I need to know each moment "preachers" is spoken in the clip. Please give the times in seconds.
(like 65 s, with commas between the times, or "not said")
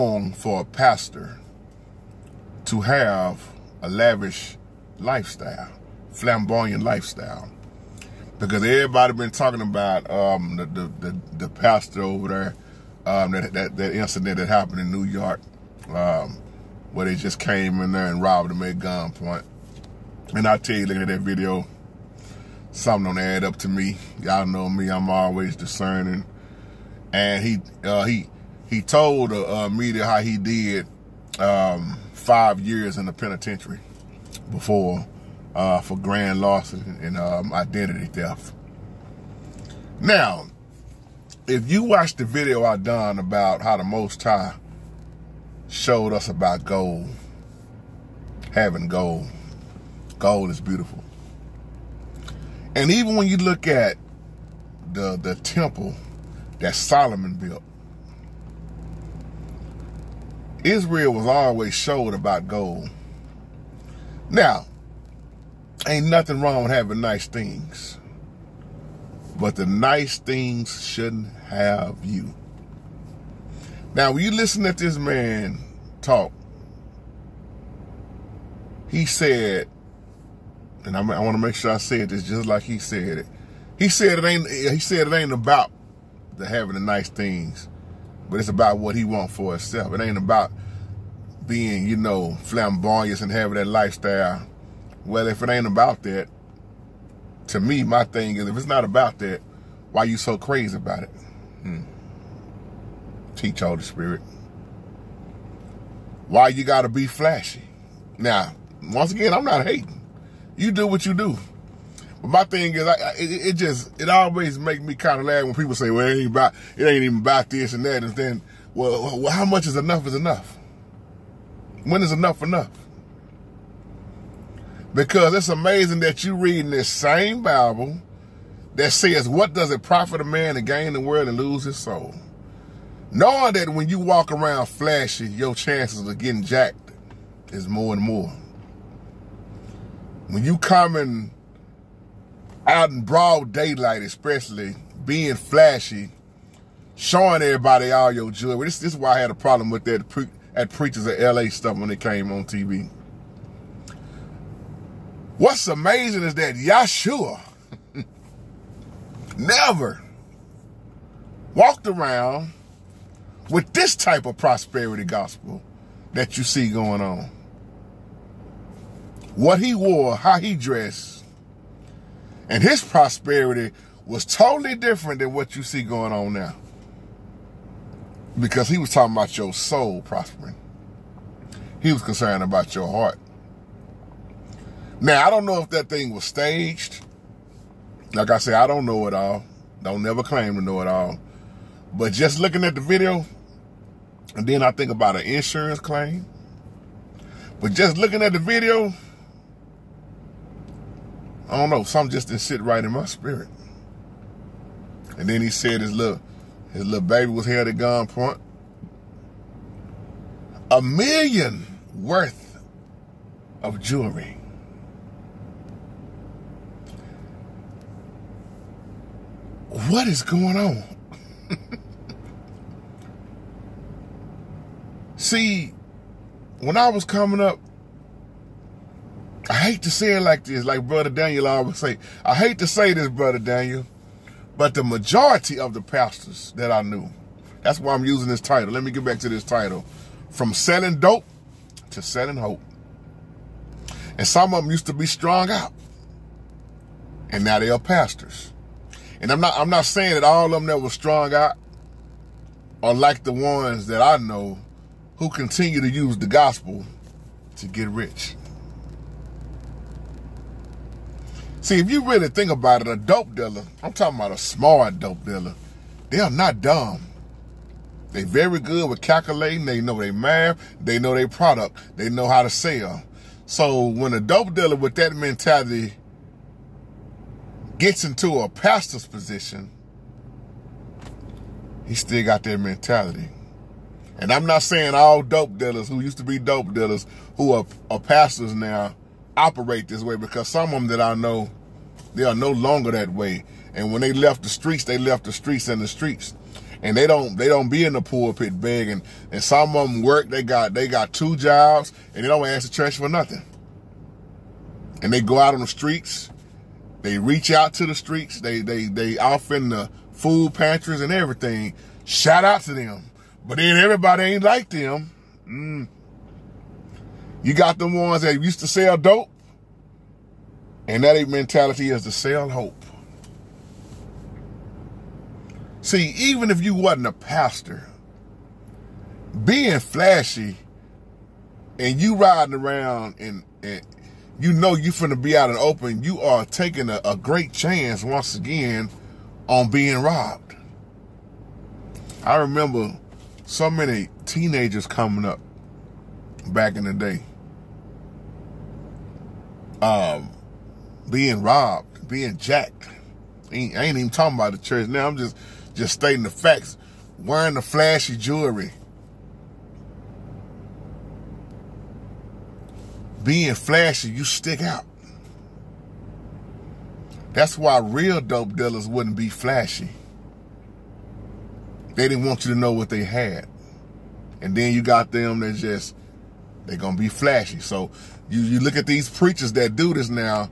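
150 s, 379 s.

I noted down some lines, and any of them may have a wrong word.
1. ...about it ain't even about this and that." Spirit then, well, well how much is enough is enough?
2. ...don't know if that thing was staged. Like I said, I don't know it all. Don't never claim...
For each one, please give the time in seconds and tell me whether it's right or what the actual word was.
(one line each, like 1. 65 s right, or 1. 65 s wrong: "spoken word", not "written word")
1. 116 s wrong: "And", not "Spirit"
2. 185 s right.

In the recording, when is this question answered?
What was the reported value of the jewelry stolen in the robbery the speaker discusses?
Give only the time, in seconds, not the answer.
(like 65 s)
210 s.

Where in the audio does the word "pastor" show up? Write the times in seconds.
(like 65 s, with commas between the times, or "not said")
0 s, 11 s, 235 s, 247 s, 278 s, 288 s, 327 s.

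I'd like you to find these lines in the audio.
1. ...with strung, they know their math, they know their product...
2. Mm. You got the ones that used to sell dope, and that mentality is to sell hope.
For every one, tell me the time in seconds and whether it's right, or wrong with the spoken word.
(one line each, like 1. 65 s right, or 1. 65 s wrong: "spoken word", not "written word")
1. 268 s wrong: "calculating", not "strung"
2. 315 s right.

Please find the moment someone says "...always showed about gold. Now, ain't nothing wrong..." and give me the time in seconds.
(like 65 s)
61 s.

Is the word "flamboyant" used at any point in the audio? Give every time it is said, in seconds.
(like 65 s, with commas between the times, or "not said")
6 s, 92 s.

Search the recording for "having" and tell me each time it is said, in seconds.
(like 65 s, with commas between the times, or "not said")
48 s, 66 s, 86 s, 93 s.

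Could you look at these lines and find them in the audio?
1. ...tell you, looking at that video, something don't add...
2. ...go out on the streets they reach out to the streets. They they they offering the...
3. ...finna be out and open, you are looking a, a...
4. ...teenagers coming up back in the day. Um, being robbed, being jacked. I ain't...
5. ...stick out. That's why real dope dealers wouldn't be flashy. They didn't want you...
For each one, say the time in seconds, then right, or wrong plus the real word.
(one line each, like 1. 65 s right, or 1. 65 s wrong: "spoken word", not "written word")
1. 20 s right
2. 305 s right
3. 334 s wrong: "taking", not "looking"
4. 344 s right
5. 364 s right.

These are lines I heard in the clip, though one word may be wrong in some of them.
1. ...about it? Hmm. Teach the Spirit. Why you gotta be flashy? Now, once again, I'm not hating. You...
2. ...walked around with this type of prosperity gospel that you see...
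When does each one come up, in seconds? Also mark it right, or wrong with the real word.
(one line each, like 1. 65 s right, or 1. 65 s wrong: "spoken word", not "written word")
1. 100 s right
2. 161 s right.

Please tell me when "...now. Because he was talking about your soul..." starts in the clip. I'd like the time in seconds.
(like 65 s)
176 s.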